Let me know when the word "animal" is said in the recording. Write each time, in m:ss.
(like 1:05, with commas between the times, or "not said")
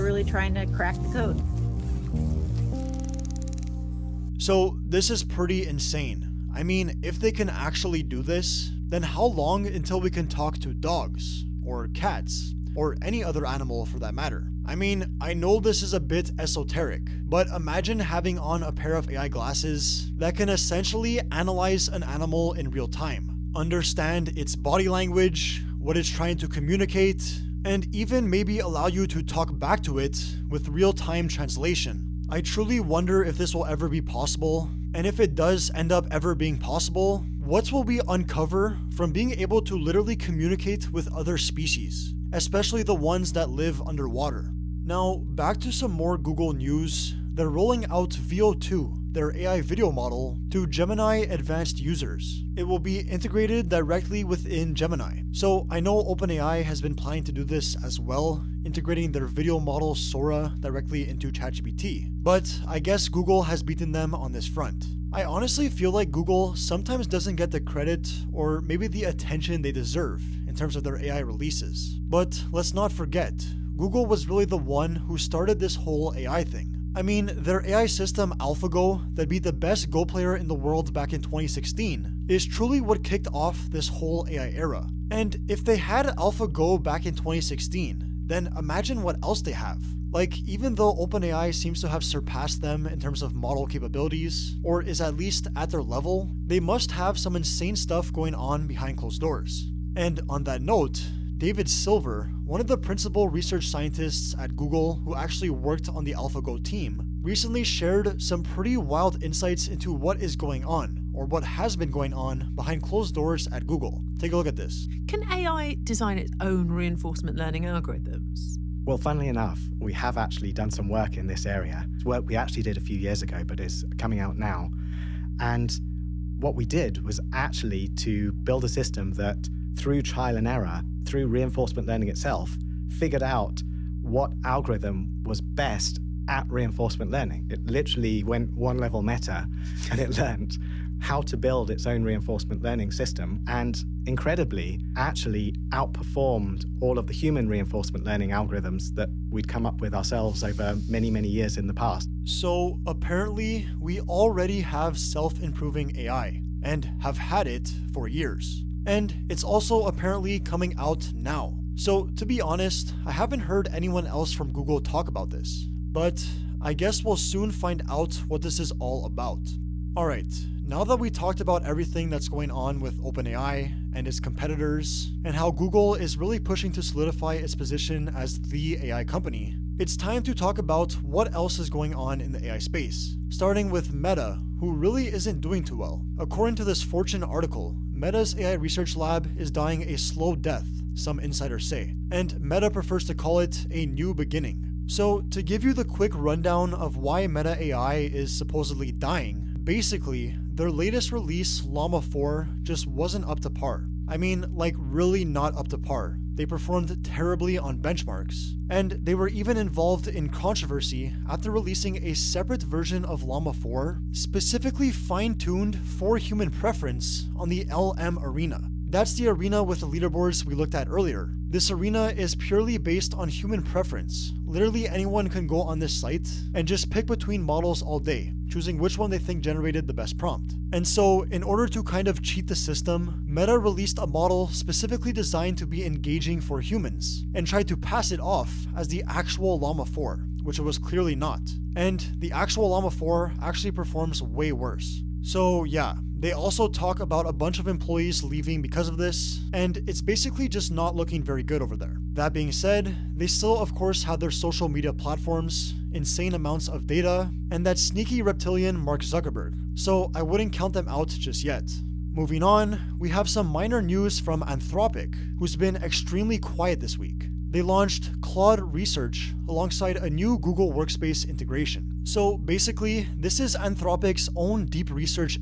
0:13, 0:22.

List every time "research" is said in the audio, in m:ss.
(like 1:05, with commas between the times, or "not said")
1:43, 3:08, 4:28, 4:34.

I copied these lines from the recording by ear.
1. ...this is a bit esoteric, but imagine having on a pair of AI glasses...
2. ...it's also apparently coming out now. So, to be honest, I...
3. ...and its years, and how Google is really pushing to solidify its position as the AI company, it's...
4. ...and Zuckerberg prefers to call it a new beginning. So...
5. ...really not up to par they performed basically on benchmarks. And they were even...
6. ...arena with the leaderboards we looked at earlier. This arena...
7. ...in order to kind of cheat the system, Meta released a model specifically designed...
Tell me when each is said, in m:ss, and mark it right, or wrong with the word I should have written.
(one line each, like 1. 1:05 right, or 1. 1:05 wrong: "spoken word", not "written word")
1. 0:15 right
2. 2:39 right
3. 2:53 wrong: "competitors", not "years"
4. 3:12 wrong: "Meta", not "Zuckerberg"
5. 3:24 wrong: "terribly", not "basically"
6. 3:39 right
7. 3:51 right.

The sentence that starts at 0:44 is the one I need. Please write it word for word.
Now, back to some more Google news.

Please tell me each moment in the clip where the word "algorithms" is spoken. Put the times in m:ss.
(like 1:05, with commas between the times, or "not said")
1:57, 2:14, 2:28.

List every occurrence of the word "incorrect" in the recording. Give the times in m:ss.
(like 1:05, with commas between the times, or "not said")
not said.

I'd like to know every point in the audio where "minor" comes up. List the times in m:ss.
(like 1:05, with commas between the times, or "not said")
4:23.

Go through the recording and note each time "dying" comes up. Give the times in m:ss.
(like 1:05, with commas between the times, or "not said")
3:09, 3:18.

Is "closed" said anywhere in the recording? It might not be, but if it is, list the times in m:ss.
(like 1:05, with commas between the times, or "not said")
1:38, 1:52.